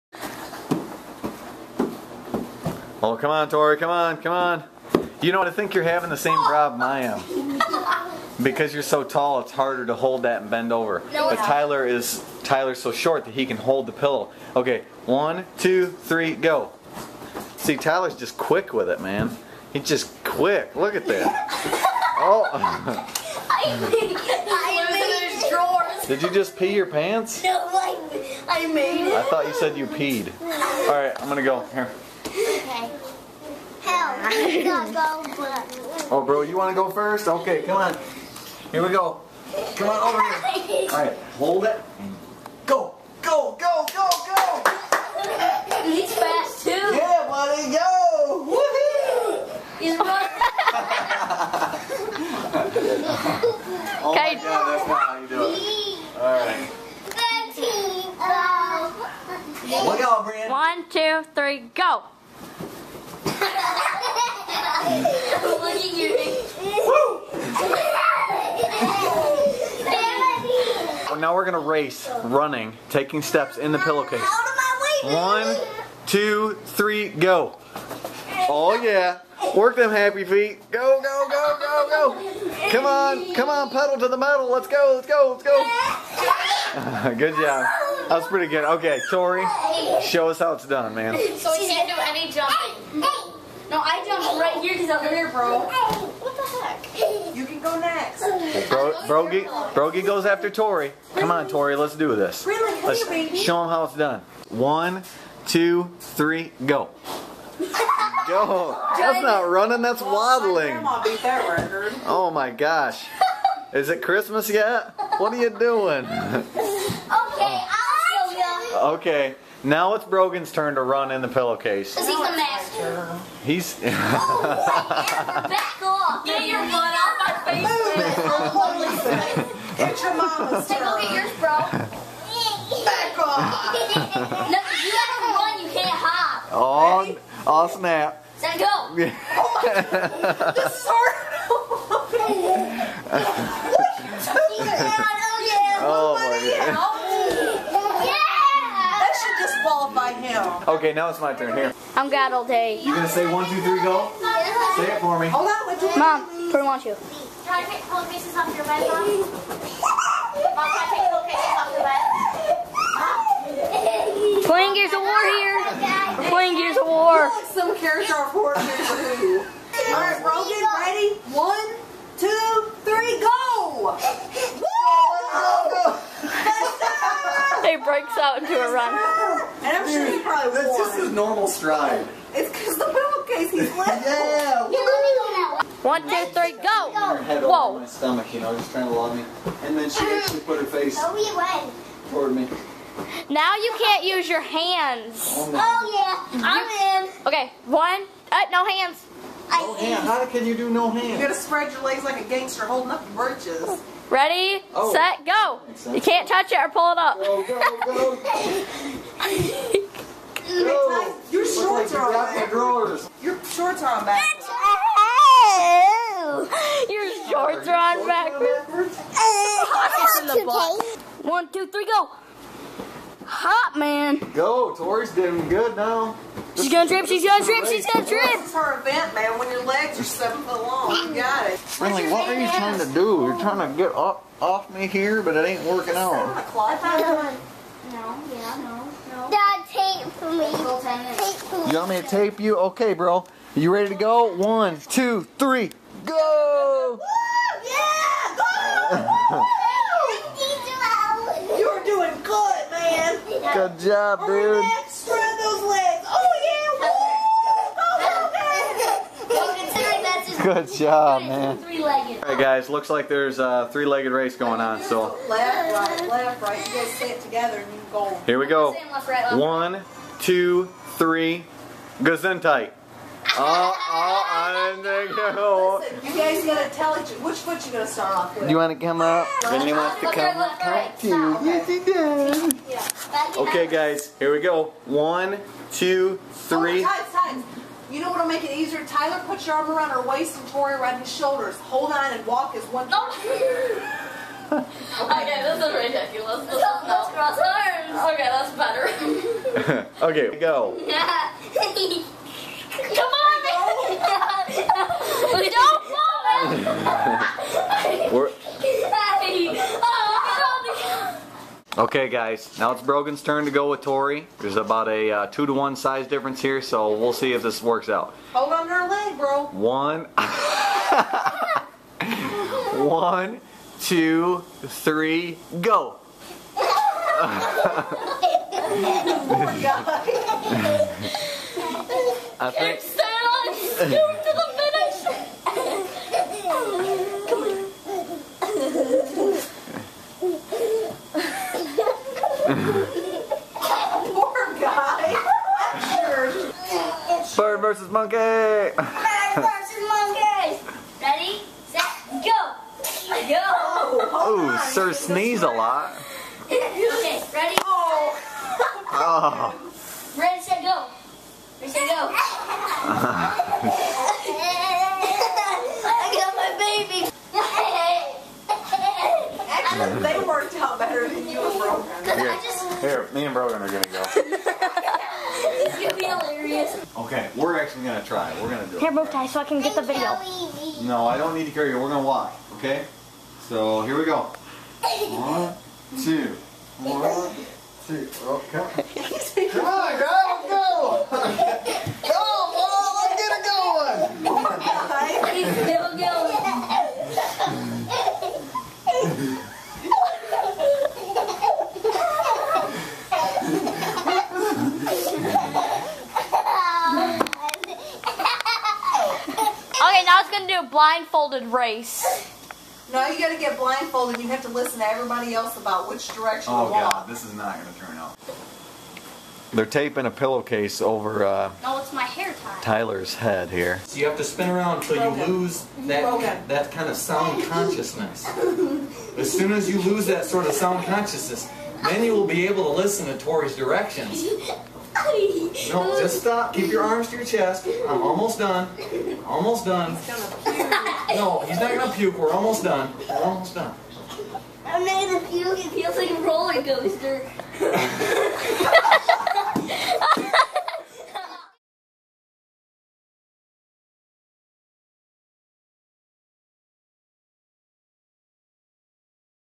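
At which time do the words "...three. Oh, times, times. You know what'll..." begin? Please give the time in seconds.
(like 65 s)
286 s.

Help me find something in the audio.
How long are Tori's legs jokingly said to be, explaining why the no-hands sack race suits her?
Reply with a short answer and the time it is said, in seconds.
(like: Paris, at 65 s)
7 feet, at 230 s.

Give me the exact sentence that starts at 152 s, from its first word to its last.
You gonna say one, two, three, go?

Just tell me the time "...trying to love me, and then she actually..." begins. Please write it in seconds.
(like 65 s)
188 s.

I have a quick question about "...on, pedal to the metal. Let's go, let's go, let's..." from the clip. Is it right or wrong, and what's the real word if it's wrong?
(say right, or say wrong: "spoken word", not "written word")
right.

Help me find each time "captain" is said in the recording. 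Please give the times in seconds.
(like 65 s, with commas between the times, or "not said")
not said.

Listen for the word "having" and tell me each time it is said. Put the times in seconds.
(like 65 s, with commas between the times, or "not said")
5 s.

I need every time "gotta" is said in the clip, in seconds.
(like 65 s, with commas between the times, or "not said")
134 s, 201 s, 276 s, 413 s.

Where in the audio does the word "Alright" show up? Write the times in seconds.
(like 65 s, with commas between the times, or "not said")
169 s, 261 s.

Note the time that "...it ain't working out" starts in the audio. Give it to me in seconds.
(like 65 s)
235 s.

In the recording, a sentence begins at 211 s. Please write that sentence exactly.
Your shorts like are on back.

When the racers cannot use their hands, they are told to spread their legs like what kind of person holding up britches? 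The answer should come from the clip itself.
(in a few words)
a gangster.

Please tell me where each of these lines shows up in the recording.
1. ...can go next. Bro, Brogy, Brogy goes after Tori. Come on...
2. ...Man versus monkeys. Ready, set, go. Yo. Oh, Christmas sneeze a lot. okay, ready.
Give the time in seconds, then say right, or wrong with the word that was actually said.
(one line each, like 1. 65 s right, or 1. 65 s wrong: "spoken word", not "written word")
1. 97 s right
2. 348 s wrong: "Sir", not "Christmas".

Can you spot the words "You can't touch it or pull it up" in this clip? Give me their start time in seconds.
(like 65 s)
205 s.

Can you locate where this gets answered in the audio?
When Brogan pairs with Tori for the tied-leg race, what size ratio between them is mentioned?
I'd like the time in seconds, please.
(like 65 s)
315 s.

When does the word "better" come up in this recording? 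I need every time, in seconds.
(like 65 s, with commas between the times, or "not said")
299 s, 370 s.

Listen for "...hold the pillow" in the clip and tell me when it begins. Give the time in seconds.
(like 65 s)
13 s.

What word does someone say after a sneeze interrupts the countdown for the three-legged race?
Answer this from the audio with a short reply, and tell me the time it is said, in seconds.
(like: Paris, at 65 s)
Gesundheit, at 271 s.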